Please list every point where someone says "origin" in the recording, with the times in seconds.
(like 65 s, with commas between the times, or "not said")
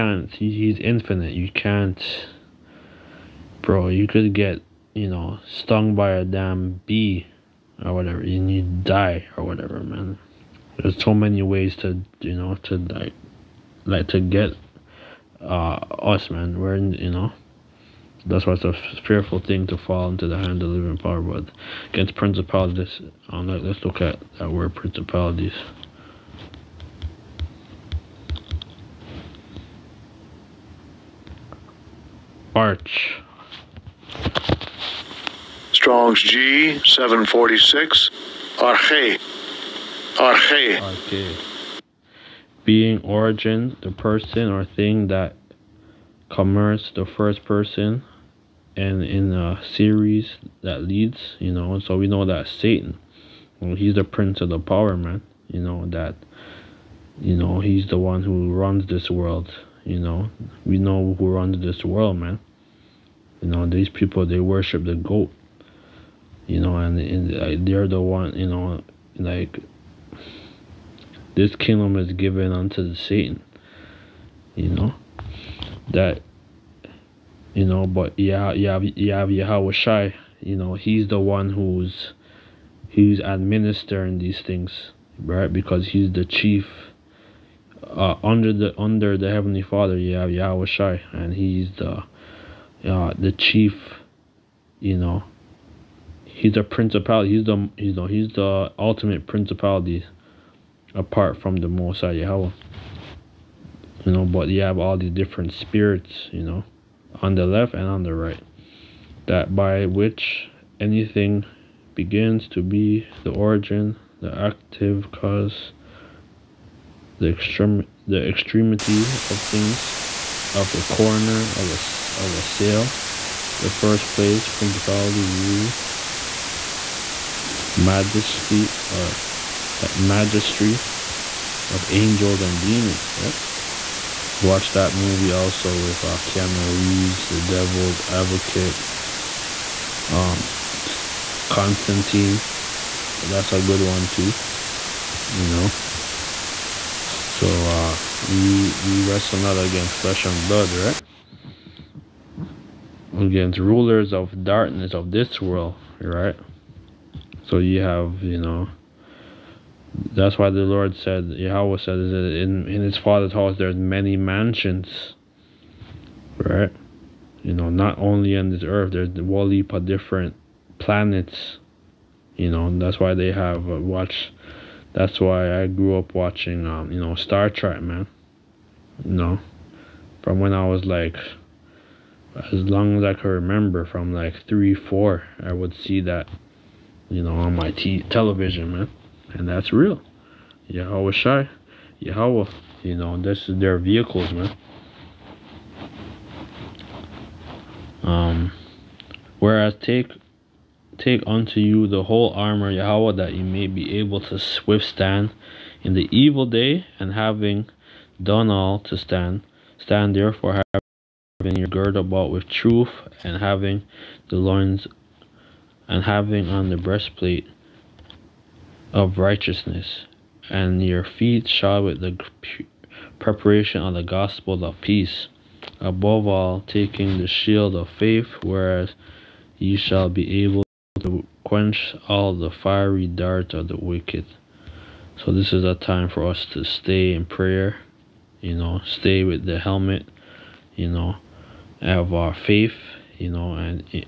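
43 s, 113 s.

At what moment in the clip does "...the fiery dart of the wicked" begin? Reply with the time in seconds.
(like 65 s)
232 s.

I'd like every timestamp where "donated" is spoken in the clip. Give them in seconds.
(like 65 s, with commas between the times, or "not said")
not said.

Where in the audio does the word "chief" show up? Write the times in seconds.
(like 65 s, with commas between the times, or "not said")
86 s, 93 s.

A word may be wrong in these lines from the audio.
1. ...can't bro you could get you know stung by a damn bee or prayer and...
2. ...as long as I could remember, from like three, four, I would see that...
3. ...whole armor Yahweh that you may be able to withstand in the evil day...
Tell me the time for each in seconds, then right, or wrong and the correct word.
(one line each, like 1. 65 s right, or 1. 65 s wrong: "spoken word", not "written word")
1. 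1 s wrong: "whatever", not "prayer"
2. 182 s right
3. 202 s right.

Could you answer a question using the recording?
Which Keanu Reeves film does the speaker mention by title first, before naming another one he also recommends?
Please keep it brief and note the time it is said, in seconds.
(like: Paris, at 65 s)
The Devil's Advocate, at 137 s.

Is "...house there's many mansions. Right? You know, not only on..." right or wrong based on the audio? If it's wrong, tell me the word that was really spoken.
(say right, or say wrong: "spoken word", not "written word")
right.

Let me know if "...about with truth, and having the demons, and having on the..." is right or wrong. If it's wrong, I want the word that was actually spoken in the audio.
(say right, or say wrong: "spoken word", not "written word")
wrong: "loins", not "demons".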